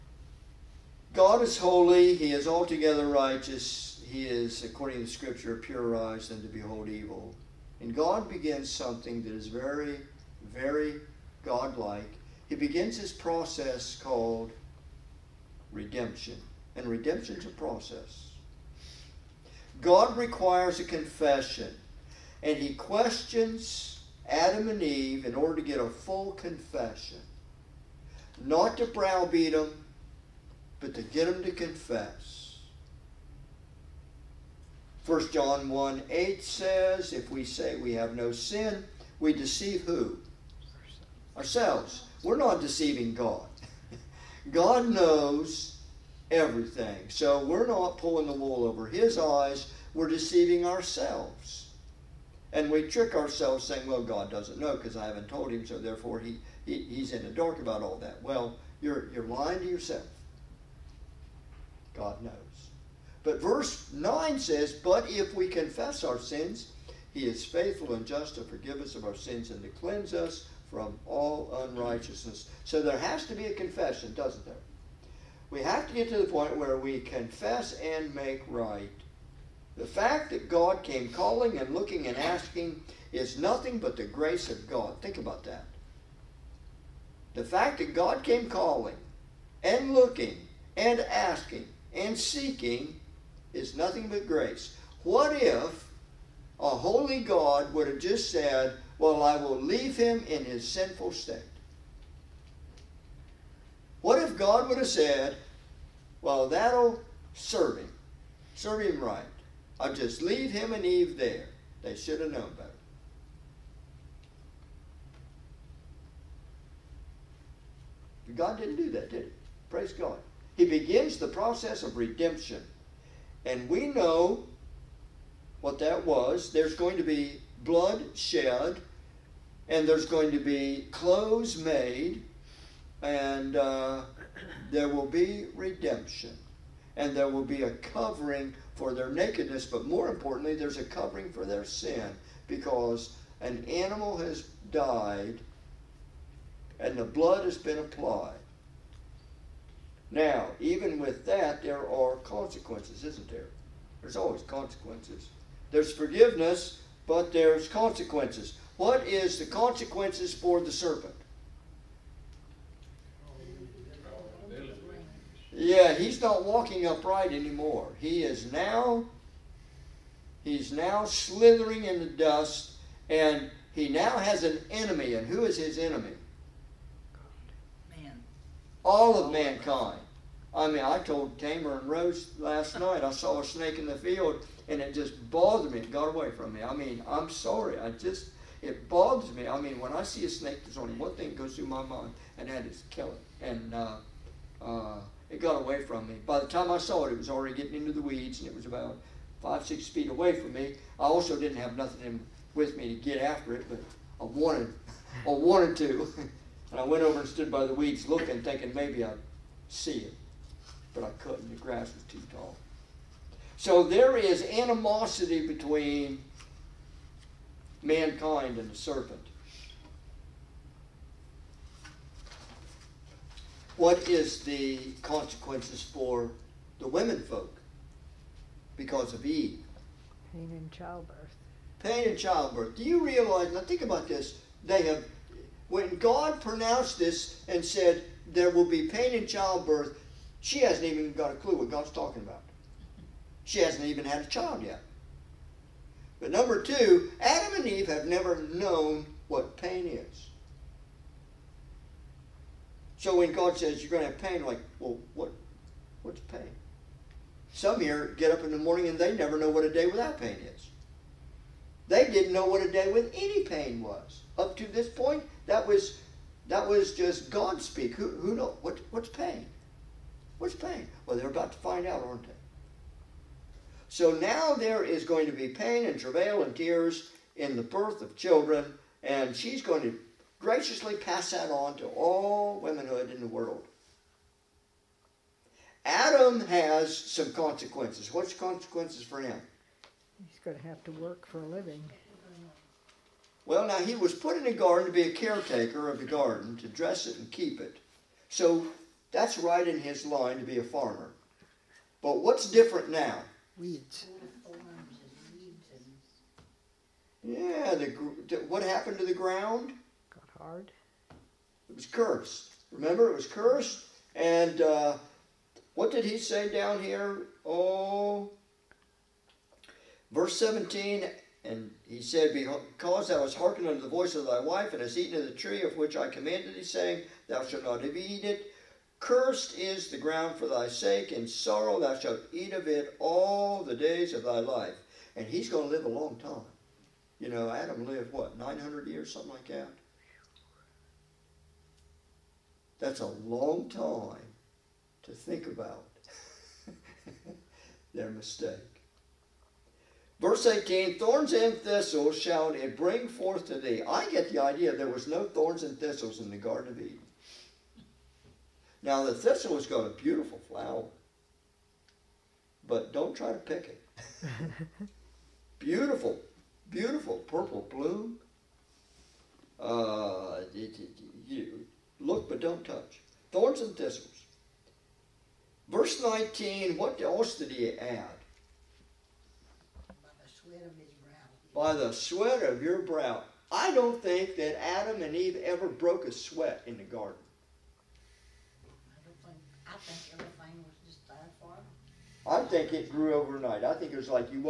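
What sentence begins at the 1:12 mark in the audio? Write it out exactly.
So there has to be a confession, doesn't there?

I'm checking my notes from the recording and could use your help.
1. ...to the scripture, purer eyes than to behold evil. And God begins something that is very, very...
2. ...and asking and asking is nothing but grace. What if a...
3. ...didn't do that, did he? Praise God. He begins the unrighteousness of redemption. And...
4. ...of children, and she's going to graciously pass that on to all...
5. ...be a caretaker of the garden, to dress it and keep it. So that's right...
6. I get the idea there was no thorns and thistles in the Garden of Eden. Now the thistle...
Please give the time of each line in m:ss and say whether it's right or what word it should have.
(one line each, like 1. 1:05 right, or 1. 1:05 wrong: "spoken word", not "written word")
1. 0:05 right
2. 1:30 wrong: "seeking", not "asking"
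3. 1:58 wrong: "process", not "unrighteousness"
4. 4:38 right
5. 4:54 right
6. 5:53 right.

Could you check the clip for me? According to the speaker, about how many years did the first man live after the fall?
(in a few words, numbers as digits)
900 years.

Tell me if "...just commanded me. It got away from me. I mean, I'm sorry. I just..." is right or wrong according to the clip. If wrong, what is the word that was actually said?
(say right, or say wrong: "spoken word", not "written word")
wrong: "bothered", not "commanded".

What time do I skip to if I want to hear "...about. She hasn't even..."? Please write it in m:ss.
4:02.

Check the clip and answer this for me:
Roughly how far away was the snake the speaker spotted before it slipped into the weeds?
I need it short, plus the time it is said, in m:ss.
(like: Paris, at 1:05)
5 or 6 feet, at 3:19.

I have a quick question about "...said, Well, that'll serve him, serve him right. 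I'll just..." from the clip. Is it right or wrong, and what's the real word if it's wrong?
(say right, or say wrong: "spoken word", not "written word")
right.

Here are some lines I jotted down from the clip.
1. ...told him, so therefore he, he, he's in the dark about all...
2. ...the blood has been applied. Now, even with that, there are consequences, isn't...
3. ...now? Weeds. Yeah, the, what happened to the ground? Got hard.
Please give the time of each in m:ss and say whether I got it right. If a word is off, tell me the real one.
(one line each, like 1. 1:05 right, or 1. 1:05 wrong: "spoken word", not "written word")
1. 0:55 right
2. 2:26 right
3. 5:02 right.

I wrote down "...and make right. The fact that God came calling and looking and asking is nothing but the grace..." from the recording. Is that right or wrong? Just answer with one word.
right.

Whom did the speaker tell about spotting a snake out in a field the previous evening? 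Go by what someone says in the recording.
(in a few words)
Tamer and Rose.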